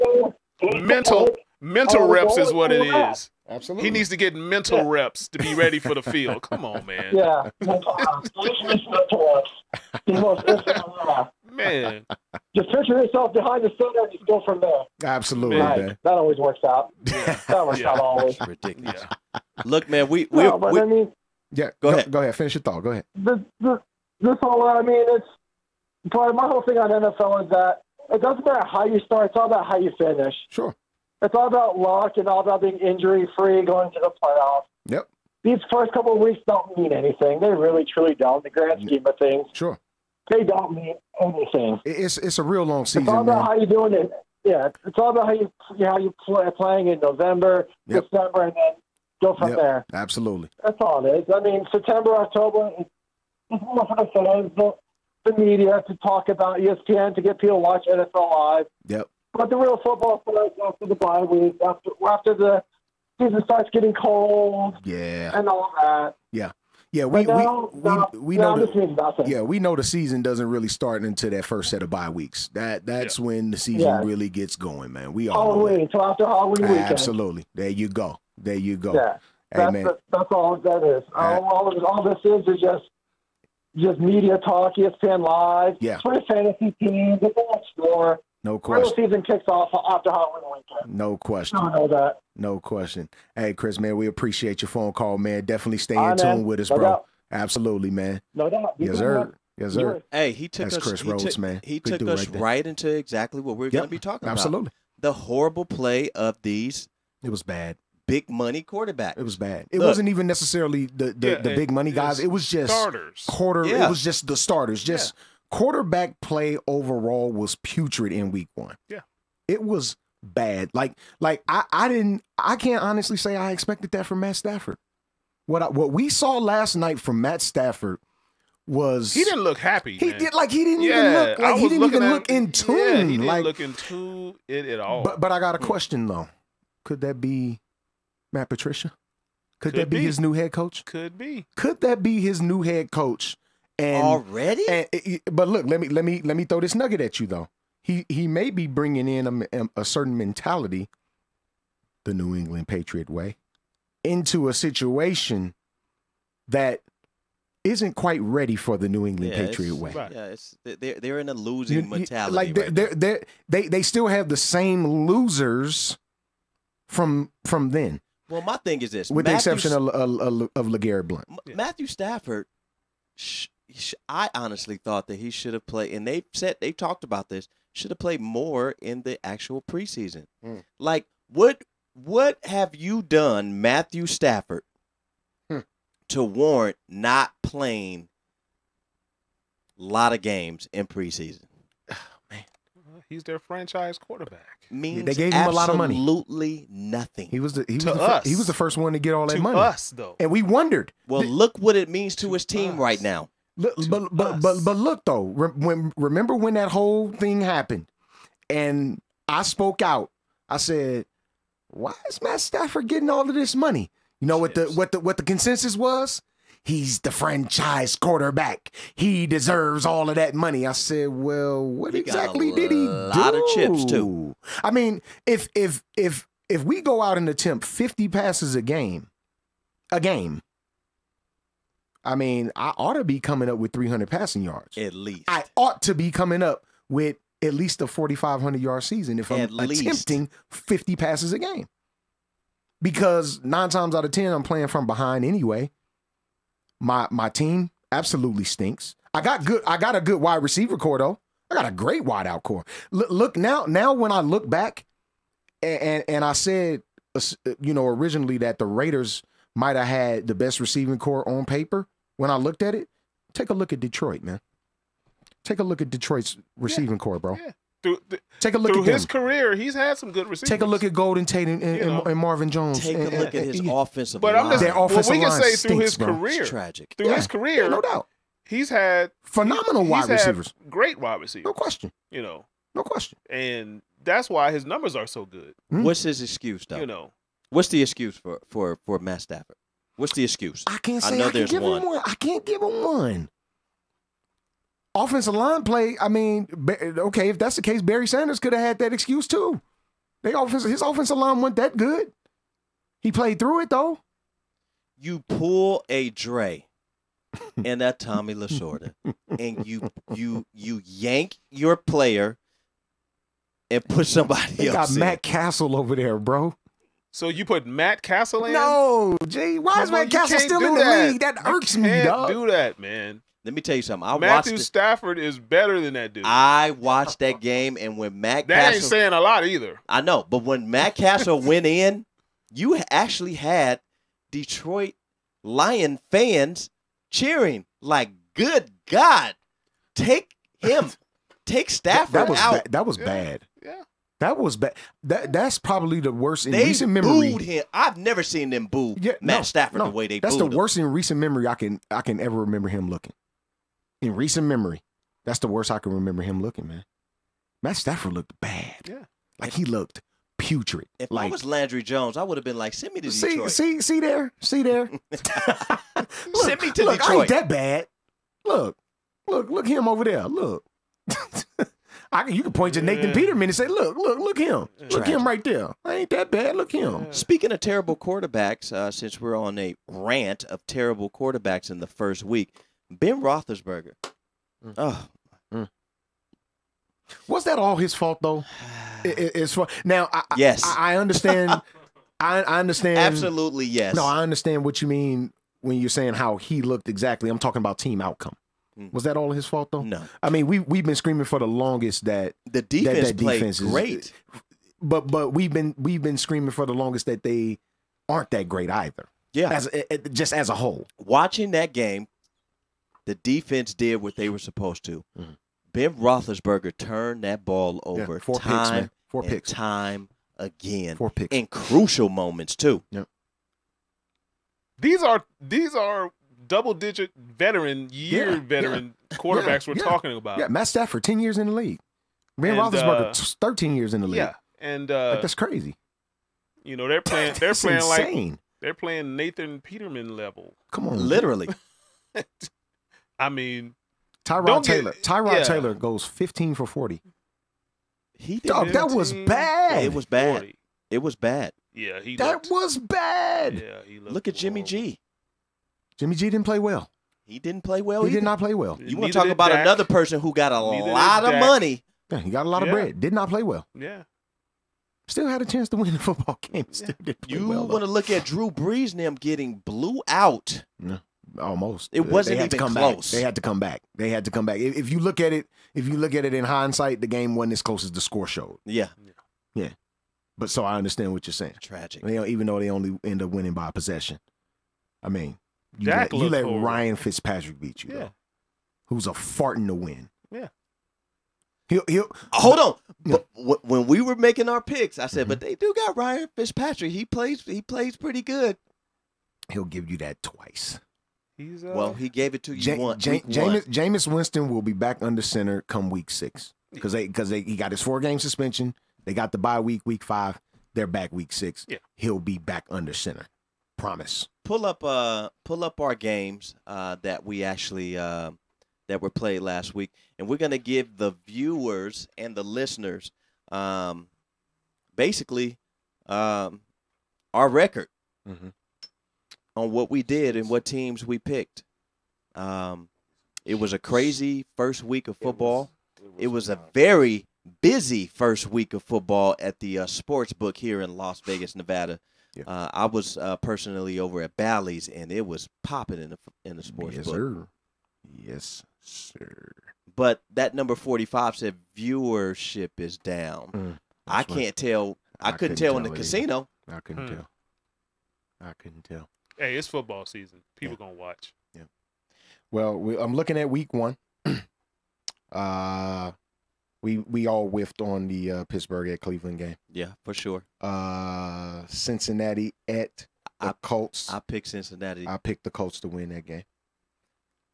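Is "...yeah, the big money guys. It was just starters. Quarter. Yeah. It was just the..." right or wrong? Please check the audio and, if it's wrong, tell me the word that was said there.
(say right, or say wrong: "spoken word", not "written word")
right.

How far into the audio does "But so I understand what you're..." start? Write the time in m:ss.
8:00.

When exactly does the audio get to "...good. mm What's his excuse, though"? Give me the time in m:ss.
4:45.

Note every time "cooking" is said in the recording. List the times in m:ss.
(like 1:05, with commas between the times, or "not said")
not said.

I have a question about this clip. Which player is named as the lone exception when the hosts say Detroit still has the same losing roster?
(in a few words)
LeGarrette Blount.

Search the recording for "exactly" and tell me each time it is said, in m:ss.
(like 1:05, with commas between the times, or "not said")
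1:42, 3:41, 6:36.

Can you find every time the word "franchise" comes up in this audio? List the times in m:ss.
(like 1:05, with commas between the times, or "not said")
3:13, 3:37.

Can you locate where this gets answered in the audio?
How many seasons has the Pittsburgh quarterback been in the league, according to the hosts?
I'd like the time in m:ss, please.
7:13.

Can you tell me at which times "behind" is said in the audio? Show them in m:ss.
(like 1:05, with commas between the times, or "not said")
0:13, 4:04.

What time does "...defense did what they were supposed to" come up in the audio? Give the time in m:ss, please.
6:53.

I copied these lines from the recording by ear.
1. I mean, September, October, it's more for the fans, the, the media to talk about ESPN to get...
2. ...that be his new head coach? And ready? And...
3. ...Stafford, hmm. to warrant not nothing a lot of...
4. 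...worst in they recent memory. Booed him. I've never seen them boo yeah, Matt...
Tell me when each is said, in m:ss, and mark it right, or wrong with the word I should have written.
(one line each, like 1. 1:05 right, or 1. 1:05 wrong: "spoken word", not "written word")
1. 0:51 right
2. 2:21 wrong: "already", not "ready"
3. 3:04 wrong: "playing", not "nothing"
4. 5:46 right.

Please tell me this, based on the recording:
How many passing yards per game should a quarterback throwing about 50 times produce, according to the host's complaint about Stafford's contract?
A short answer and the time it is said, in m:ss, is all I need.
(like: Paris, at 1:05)
300, at 3:53.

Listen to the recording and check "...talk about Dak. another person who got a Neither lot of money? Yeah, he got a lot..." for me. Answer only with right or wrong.
right.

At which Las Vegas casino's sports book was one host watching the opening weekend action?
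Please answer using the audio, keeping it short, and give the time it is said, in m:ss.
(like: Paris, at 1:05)
Bally's, at 9:04.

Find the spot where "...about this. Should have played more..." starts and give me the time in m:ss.
2:57.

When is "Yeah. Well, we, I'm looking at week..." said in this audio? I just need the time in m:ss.
9:21.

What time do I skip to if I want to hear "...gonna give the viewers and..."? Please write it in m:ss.
8:40.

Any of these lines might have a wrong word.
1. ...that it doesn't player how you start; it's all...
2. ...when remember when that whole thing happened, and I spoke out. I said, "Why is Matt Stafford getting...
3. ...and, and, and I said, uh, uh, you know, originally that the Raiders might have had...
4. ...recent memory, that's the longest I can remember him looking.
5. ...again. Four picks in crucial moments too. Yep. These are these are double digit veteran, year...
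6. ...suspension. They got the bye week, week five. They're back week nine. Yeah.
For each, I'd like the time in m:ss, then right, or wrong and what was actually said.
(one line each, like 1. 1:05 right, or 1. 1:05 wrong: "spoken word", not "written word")
1. 0:27 wrong: "matter", not "player"
2. 3:25 right
3. 4:15 right
4. 5:54 wrong: "worst", not "longest"
5. 7:00 right
6. 8:28 wrong: "six", not "nine".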